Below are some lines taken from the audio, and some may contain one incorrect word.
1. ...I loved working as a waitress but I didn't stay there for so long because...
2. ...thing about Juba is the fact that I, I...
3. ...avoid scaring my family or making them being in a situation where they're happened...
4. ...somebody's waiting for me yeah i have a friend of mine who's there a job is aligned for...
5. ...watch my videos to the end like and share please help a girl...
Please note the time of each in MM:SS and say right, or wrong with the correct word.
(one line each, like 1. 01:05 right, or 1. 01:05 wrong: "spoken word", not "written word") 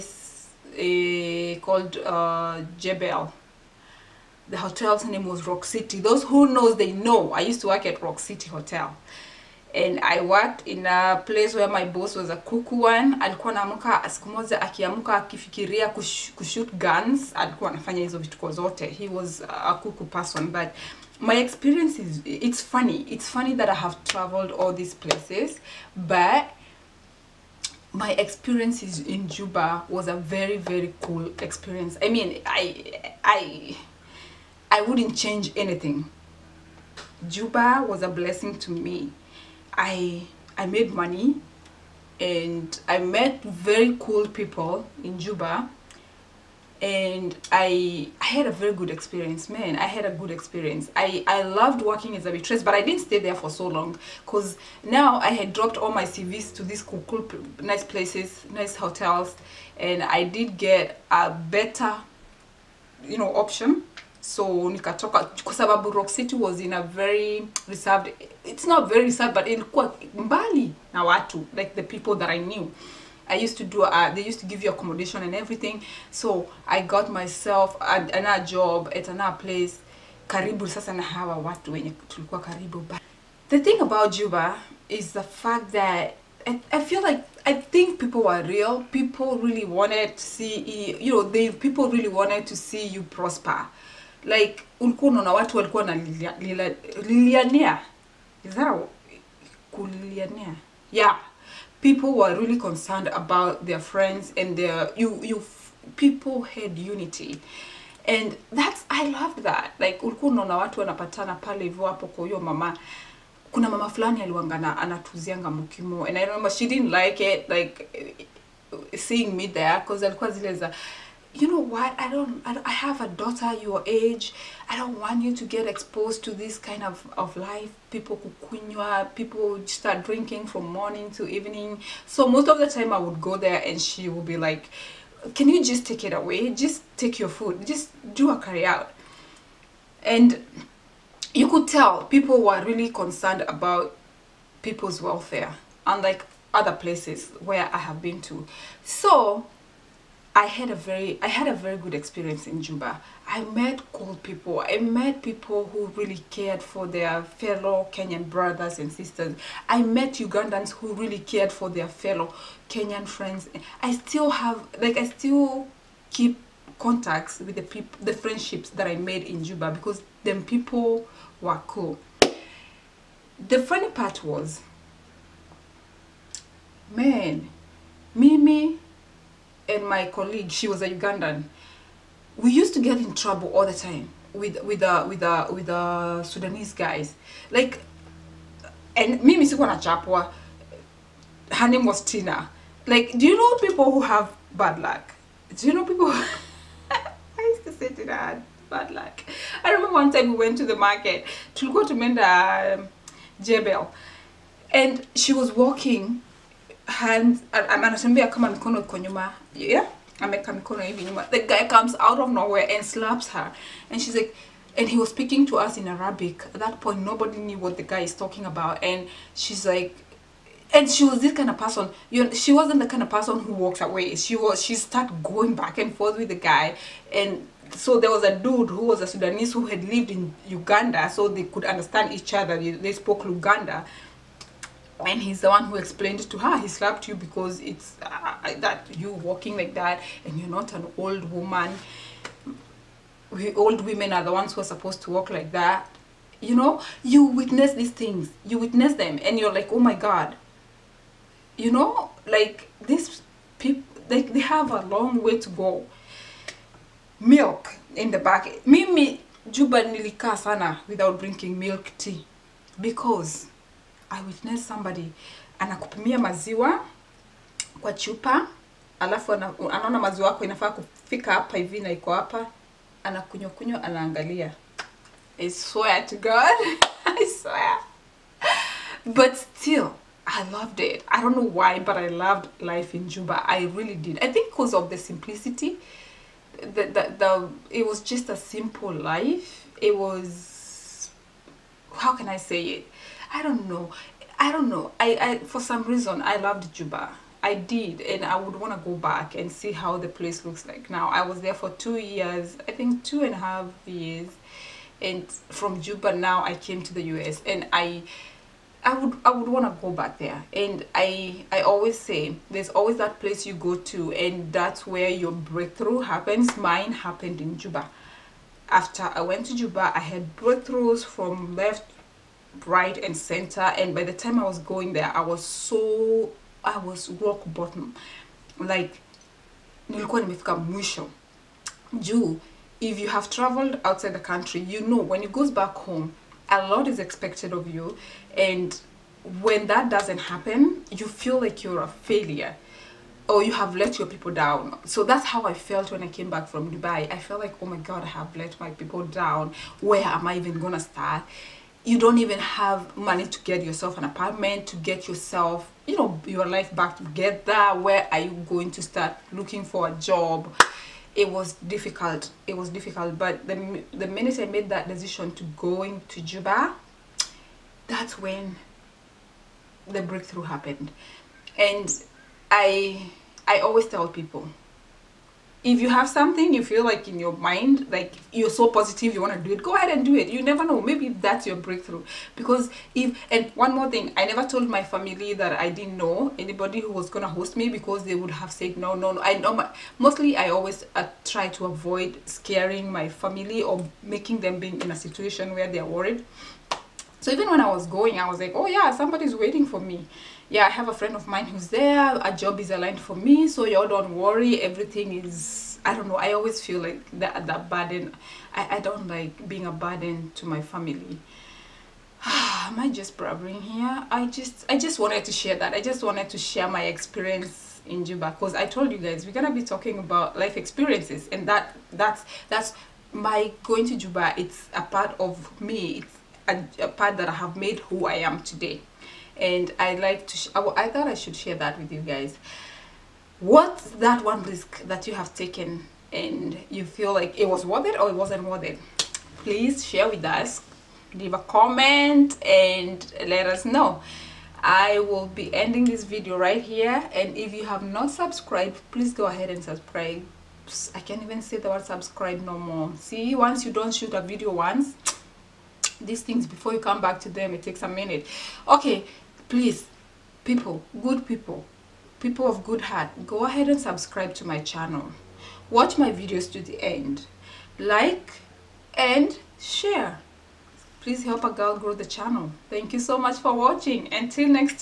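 1. 00:51 right
2. 01:23 right
3. 06:31 wrong: "worried", not "happened"
4. 06:38 right
5. 07:45 right.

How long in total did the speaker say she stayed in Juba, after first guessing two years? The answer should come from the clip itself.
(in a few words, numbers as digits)
2 and a half years.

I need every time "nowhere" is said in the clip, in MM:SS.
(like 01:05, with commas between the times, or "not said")
03:32.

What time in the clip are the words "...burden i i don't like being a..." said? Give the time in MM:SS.
06:47.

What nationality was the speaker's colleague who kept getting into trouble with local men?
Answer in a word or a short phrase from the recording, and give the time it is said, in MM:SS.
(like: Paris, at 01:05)
Ugandan, at 03:00.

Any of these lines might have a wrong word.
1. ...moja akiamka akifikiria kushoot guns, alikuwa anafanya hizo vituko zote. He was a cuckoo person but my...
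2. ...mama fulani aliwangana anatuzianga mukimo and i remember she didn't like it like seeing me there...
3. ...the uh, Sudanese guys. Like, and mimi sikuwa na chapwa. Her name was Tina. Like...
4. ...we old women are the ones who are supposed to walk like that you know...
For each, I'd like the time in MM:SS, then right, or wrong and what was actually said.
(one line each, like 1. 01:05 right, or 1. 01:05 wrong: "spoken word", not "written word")
1. 00:14 right
2. 01:53 right
3. 03:05 right
4. 04:03 right.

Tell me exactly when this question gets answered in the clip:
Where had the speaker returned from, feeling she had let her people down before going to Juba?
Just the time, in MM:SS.
05:46.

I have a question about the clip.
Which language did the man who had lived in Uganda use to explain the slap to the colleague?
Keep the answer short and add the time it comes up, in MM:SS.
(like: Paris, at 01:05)
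Luganda, at 03:53.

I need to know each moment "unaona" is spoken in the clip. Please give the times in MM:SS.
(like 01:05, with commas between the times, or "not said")
01:35, 01:50.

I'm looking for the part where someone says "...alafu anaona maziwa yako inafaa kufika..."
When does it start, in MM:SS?
04:28.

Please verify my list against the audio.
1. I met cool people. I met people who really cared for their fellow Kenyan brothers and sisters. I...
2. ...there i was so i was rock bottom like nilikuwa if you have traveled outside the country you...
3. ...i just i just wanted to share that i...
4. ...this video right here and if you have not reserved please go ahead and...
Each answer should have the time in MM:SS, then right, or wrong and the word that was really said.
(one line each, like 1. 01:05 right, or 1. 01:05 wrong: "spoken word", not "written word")
1. 02:33 right
2. 05:24 right
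3. 06:54 right
4. 07:25 wrong: "subscribed", not "reserved".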